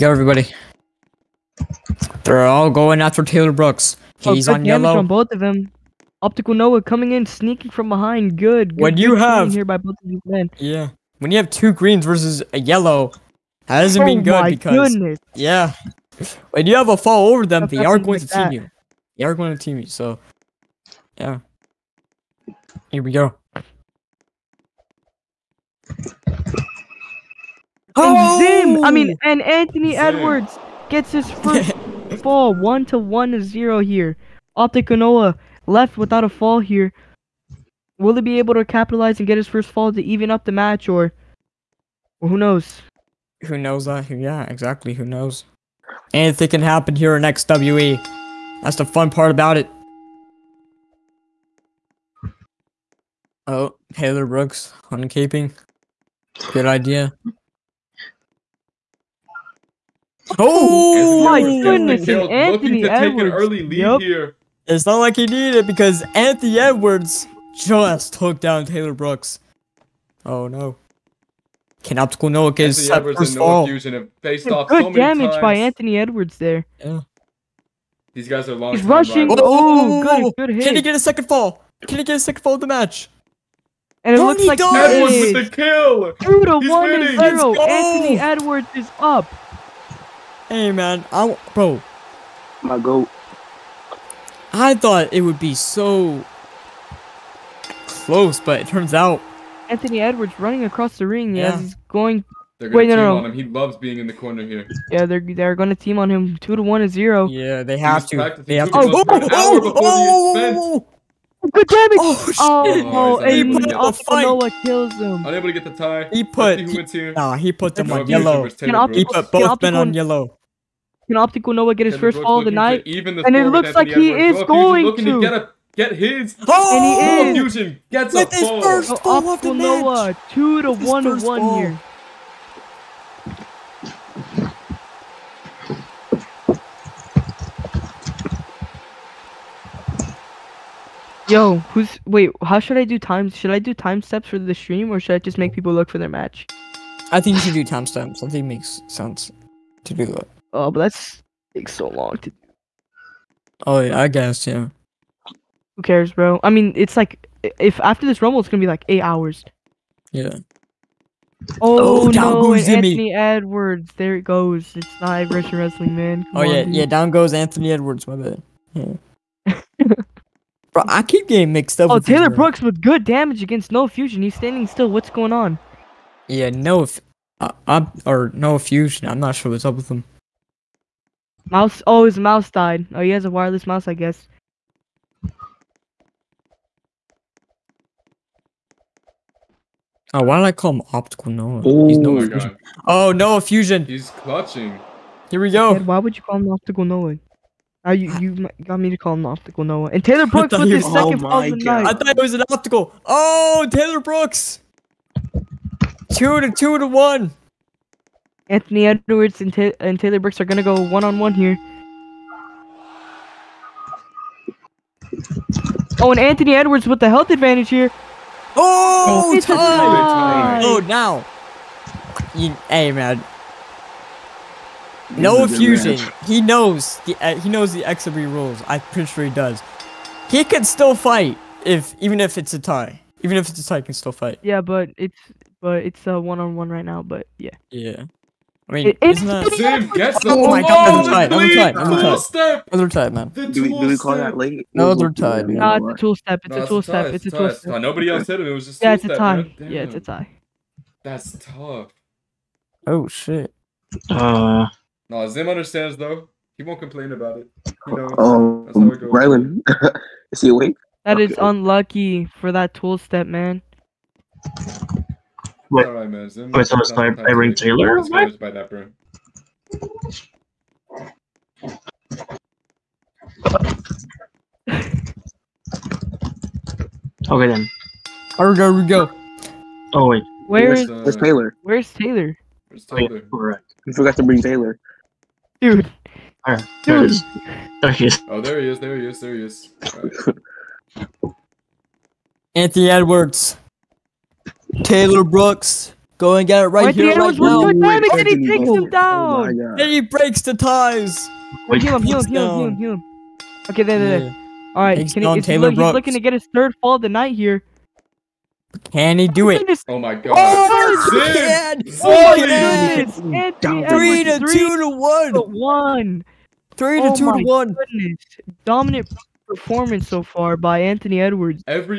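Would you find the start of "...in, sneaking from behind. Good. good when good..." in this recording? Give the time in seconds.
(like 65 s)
7 s.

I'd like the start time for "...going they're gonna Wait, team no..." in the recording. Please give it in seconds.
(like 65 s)
101 s.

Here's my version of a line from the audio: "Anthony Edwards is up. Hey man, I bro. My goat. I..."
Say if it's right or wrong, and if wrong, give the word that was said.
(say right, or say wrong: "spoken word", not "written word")
right.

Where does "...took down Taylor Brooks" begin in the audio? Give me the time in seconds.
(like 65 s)
68 s.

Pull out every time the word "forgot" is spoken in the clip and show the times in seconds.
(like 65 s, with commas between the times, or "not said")
283 s.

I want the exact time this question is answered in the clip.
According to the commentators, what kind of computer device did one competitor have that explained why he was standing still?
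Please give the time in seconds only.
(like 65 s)
183 s.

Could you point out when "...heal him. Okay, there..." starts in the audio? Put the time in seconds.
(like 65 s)
302 s.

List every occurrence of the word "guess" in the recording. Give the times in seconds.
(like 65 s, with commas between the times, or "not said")
154 s, 183 s.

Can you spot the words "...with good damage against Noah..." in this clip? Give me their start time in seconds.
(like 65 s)
172 s.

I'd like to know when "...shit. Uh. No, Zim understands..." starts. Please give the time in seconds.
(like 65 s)
253 s.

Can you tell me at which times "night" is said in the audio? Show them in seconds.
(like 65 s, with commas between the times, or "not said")
122 s, 201 s, 307 s.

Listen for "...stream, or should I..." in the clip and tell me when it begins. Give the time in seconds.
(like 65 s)
144 s.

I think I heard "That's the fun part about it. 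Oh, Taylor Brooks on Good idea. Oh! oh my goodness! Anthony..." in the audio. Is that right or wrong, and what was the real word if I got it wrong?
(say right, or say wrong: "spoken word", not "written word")
right.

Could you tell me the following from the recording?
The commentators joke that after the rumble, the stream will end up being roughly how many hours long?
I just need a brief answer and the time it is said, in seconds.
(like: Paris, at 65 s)
8 hours, at 158 s.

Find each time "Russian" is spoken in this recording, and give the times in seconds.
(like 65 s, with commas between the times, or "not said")
165 s.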